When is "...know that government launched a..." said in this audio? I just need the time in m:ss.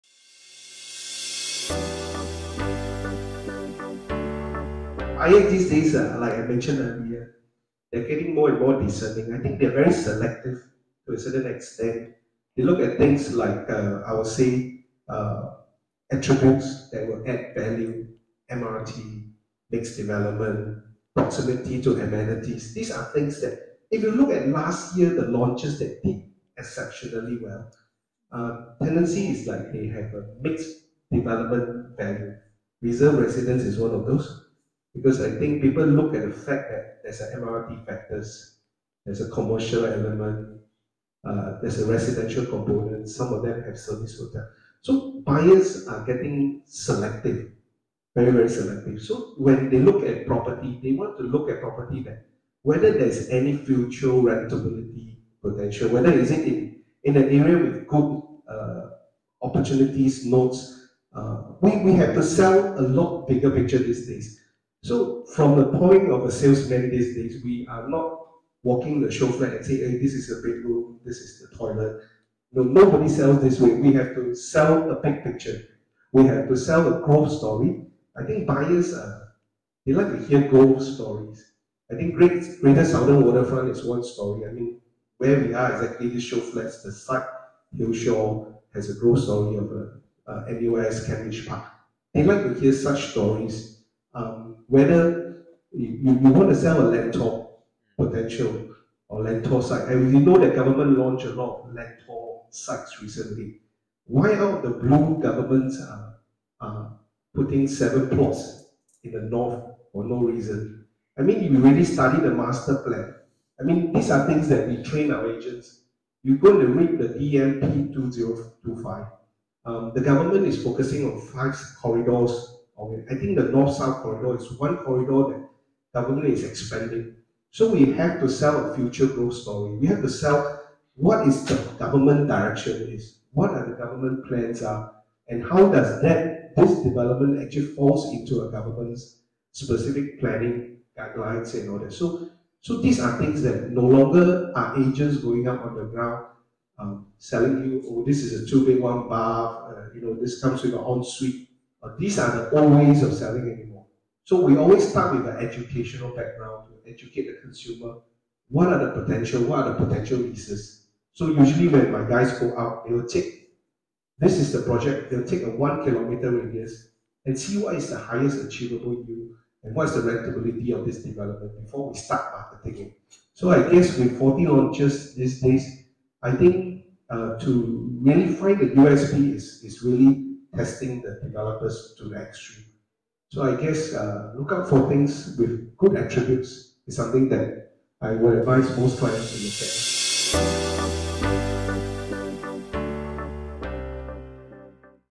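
1:40.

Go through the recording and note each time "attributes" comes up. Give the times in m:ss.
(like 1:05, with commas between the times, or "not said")
0:16, 3:05.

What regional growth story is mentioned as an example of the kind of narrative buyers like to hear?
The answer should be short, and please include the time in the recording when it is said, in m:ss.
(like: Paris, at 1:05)
Greater Southern Waterfront, at 1:22.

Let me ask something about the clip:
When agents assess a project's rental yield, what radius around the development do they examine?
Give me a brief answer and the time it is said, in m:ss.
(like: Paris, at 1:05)
1 kilometer, at 2:45.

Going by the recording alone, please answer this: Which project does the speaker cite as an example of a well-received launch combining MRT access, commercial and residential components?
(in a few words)
Reserve Residence.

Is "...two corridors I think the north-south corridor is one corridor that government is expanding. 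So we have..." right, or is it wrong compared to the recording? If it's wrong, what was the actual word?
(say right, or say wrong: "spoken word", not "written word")
wrong: "five", not "two".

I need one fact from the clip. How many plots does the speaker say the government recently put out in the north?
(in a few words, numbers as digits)
7.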